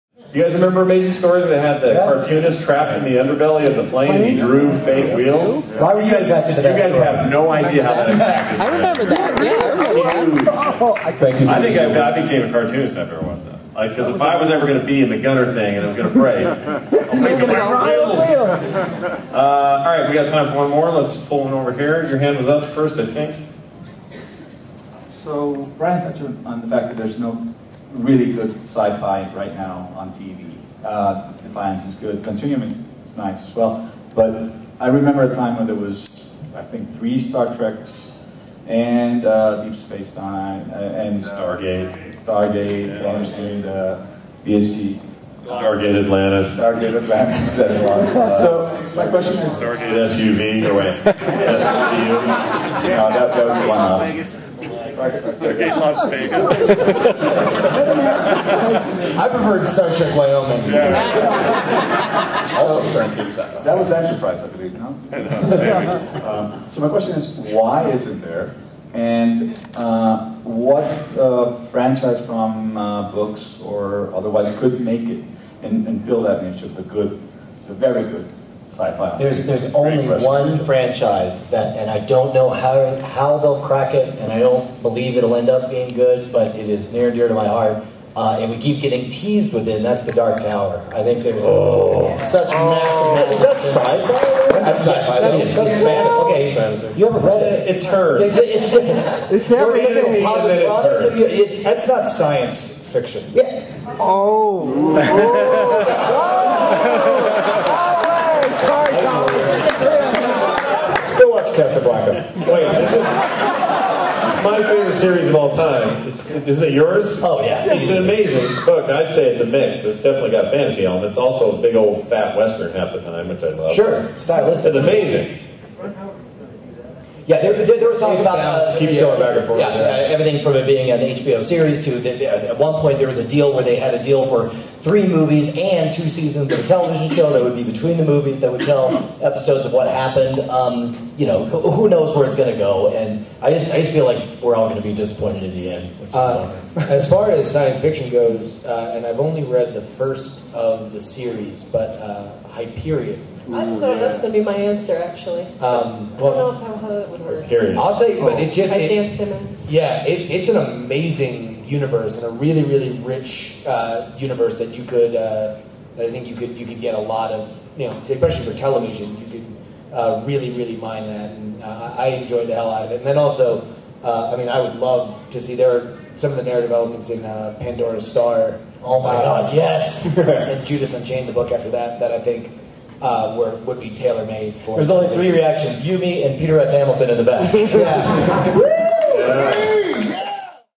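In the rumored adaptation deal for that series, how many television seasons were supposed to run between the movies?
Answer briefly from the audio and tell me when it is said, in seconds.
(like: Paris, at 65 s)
2, at 135 s.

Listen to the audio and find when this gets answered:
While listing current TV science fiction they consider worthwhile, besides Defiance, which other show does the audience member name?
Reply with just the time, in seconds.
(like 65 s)
32 s.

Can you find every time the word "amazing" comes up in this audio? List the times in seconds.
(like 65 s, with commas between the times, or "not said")
0 s, 117 s, 124 s, 160 s.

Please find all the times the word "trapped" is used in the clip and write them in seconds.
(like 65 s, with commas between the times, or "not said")
2 s.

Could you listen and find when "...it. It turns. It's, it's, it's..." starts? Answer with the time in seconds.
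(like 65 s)
97 s.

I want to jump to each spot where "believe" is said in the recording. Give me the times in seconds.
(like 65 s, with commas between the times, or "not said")
64 s, 84 s.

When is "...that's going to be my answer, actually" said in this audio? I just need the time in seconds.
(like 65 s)
153 s.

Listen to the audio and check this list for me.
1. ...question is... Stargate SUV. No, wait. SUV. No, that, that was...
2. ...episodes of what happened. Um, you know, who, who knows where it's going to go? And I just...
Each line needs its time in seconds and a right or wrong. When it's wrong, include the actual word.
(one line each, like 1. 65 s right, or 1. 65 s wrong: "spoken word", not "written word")
1. 49 s right
2. 139 s right.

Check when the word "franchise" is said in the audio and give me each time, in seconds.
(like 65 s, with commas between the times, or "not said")
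71 s, 80 s.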